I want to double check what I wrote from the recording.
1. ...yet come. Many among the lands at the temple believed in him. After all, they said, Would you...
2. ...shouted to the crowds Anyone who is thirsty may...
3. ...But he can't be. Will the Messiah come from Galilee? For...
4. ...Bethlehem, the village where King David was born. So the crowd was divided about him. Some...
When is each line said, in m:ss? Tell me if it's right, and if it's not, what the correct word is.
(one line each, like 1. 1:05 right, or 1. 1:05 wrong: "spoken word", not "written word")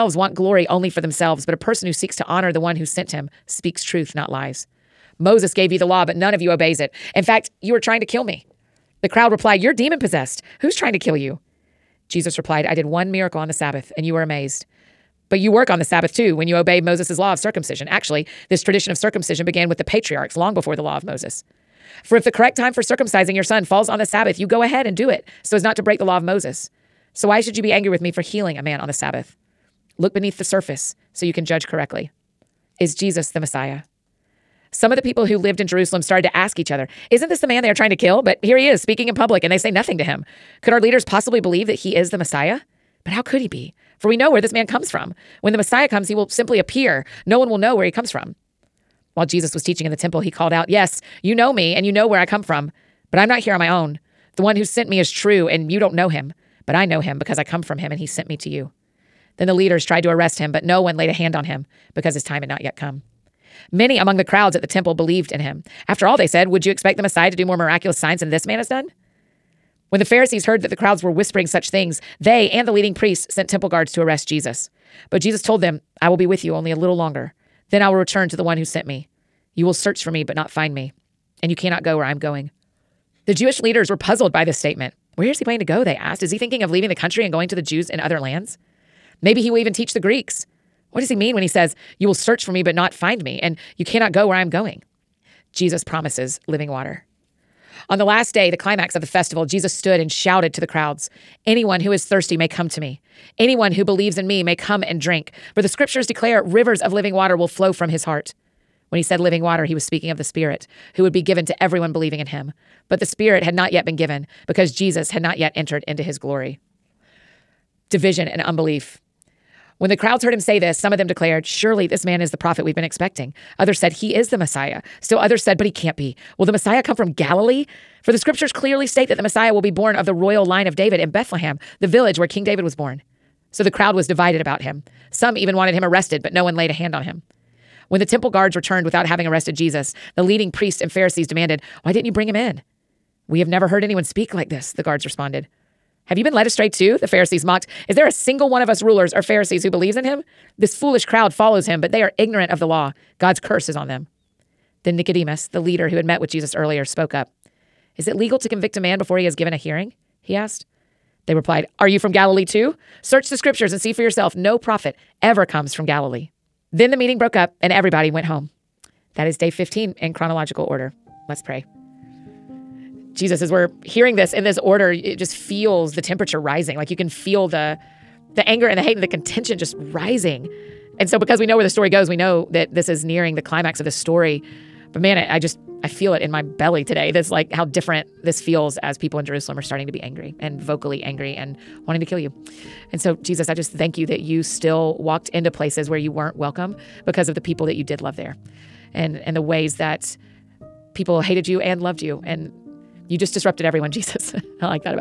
1. 1:02 wrong: "crowds", not "lands"
2. 1:40 right
3. 2:05 right
4. 2:11 right.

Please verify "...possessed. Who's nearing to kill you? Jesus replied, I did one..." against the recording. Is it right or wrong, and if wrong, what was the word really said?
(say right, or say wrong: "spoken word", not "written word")
wrong: "trying", not "nearing".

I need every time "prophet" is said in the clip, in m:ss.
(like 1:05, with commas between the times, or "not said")
2:02, 2:44.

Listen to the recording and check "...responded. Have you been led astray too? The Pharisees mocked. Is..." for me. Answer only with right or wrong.
right.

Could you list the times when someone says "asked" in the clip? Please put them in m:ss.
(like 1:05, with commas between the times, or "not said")
1:25, 2:40.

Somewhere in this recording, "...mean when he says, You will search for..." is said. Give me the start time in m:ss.
1:31.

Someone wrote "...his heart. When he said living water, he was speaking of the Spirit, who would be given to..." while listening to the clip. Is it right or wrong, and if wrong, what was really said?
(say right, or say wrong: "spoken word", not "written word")
right.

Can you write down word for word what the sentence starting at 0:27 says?
So why should you be angry with me for healing a man on the Sabbath?